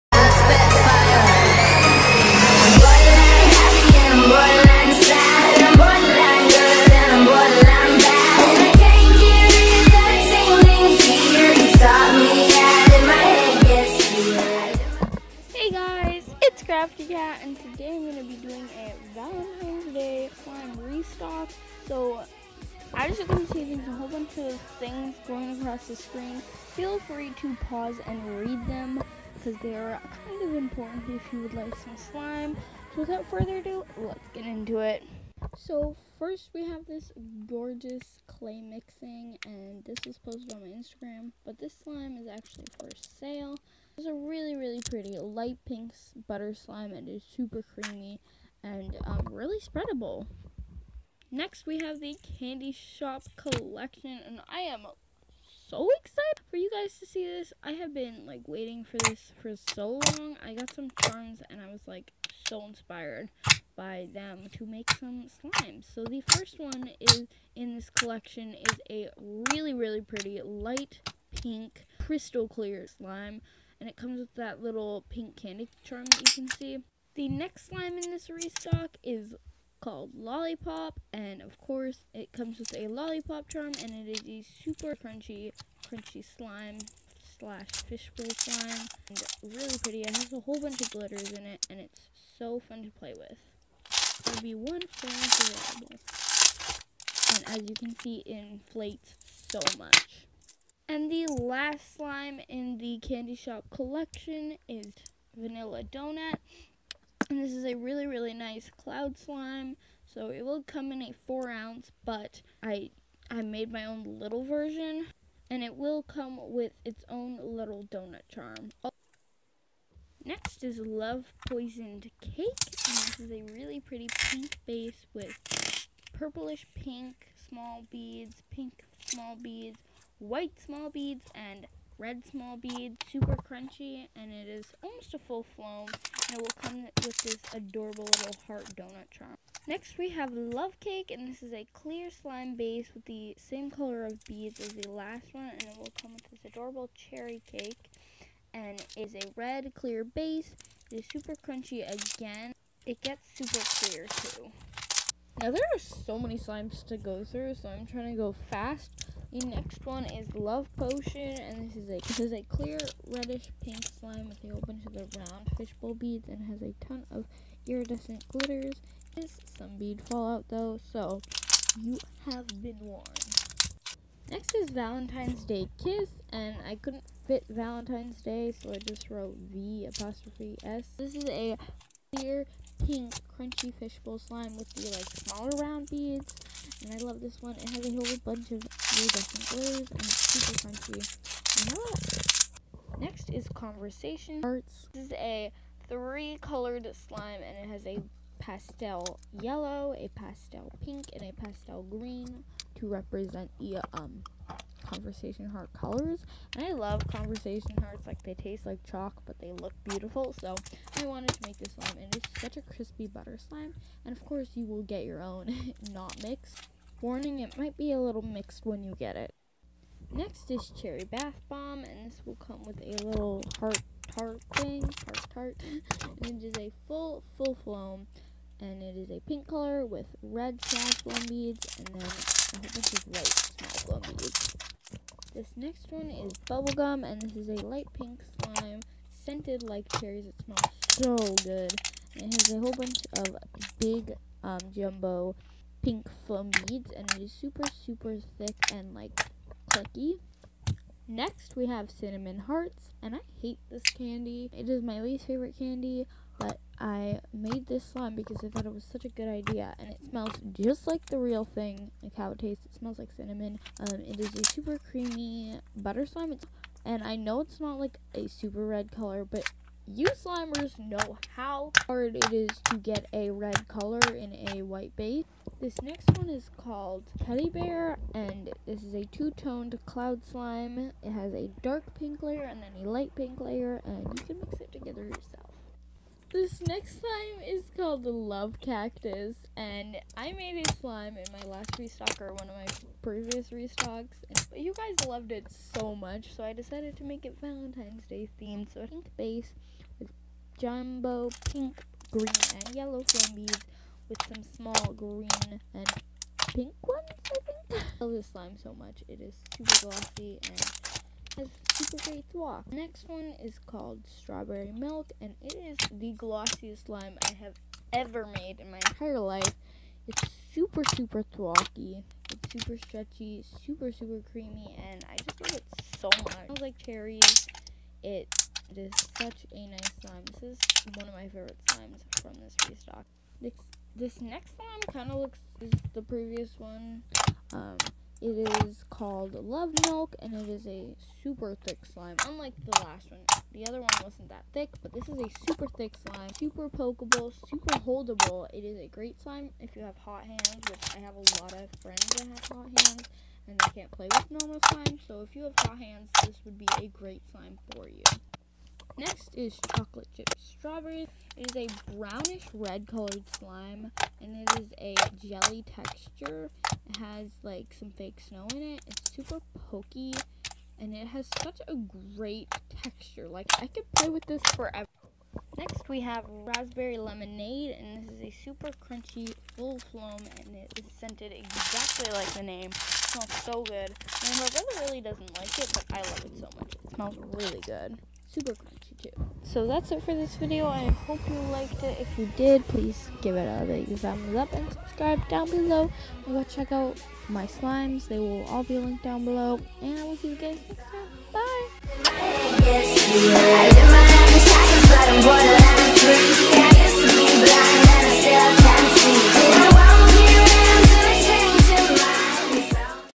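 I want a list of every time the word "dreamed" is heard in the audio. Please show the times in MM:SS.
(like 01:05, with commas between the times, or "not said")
not said.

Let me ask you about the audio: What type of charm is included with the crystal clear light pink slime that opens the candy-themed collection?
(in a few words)
pink candy charm.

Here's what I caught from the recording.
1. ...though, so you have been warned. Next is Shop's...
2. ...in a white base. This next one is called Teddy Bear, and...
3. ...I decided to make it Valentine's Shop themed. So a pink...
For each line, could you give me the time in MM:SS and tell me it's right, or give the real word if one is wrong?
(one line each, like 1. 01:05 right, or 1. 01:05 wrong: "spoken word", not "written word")
1. 02:50 wrong: "Valentine", not "Shop"
2. 04:34 right
3. 04:56 wrong: "Day", not "Shop".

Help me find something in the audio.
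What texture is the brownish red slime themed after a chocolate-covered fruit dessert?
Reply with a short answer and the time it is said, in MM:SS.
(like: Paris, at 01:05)
jelly, at 06:05.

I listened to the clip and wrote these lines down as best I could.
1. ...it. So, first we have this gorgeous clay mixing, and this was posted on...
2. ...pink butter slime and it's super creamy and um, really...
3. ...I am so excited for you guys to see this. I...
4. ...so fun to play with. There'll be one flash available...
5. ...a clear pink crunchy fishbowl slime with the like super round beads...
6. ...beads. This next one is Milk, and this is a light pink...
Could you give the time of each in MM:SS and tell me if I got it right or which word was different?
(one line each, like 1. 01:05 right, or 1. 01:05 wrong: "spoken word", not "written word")
1. 00:34 right
2. 00:45 right
3. 00:54 right
4. 01:32 right
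5. 03:01 wrong: "smaller", not "super"
6. 03:54 wrong: "Bubblegum", not "Milk".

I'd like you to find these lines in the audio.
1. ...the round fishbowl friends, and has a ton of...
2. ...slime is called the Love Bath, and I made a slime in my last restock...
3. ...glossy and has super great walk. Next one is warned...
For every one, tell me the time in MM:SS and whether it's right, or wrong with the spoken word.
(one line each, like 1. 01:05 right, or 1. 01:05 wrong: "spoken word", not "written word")
1. 02:44 wrong: "beads", not "friends"
2. 04:46 wrong: "Cactus", not "Bath"
3. 05:09 wrong: "called", not "warned".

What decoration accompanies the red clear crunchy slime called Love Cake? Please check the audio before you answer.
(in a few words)
cherry cake.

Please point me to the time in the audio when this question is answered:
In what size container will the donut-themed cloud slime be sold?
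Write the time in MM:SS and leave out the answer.
01:51.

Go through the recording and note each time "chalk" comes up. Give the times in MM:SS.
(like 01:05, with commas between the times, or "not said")
03:28.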